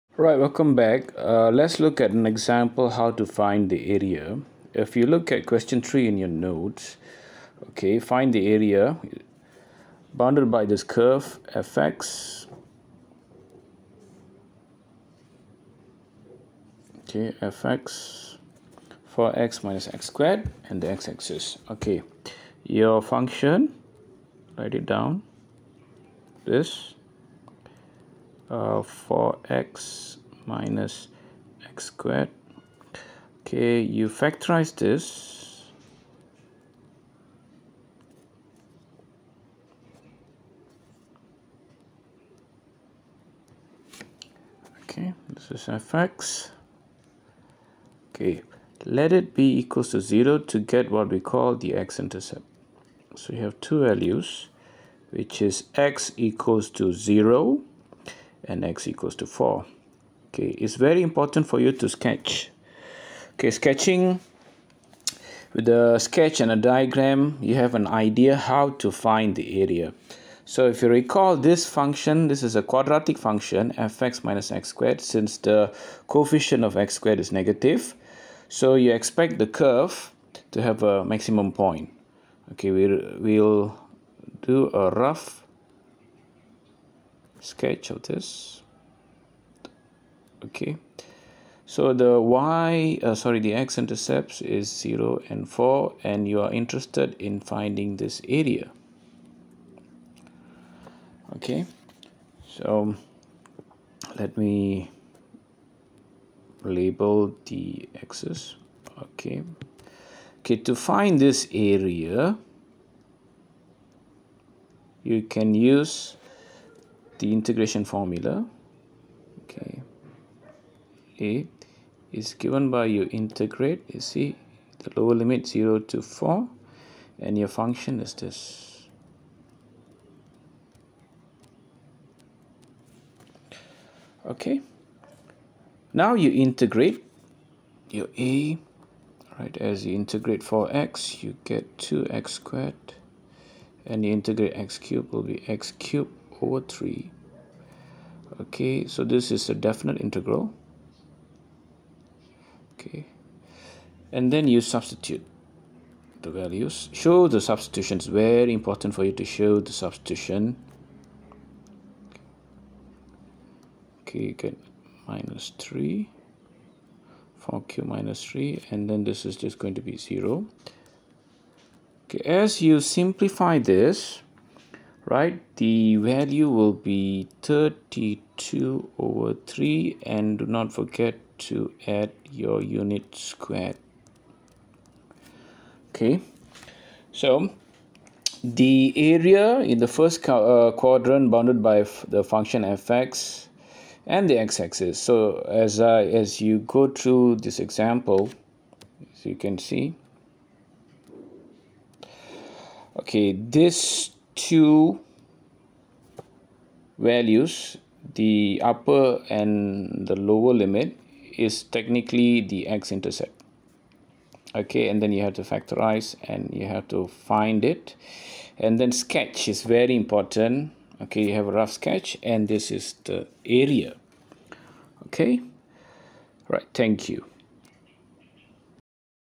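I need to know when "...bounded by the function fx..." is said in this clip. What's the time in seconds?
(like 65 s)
191 s.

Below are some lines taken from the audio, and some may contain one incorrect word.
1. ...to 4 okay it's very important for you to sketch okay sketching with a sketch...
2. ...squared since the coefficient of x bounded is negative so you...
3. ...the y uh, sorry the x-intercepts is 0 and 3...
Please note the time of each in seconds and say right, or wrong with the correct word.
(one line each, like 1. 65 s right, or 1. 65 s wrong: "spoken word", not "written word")
1. 59 s right
2. 74 s wrong: "squared", not "bounded"
3. 91 s wrong: "4", not "3".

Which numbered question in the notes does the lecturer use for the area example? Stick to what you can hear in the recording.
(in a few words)
3.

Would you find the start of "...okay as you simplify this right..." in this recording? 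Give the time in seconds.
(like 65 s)
172 s.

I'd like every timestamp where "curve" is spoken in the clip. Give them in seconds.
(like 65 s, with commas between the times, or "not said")
10 s, 79 s.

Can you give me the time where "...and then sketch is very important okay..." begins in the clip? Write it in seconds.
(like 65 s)
218 s.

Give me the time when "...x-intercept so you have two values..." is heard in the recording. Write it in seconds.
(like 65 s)
51 s.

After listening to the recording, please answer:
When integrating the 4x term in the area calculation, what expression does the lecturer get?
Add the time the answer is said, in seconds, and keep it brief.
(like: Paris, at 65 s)
2x squared, at 141 s.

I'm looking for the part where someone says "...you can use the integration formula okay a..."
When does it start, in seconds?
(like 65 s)
115 s.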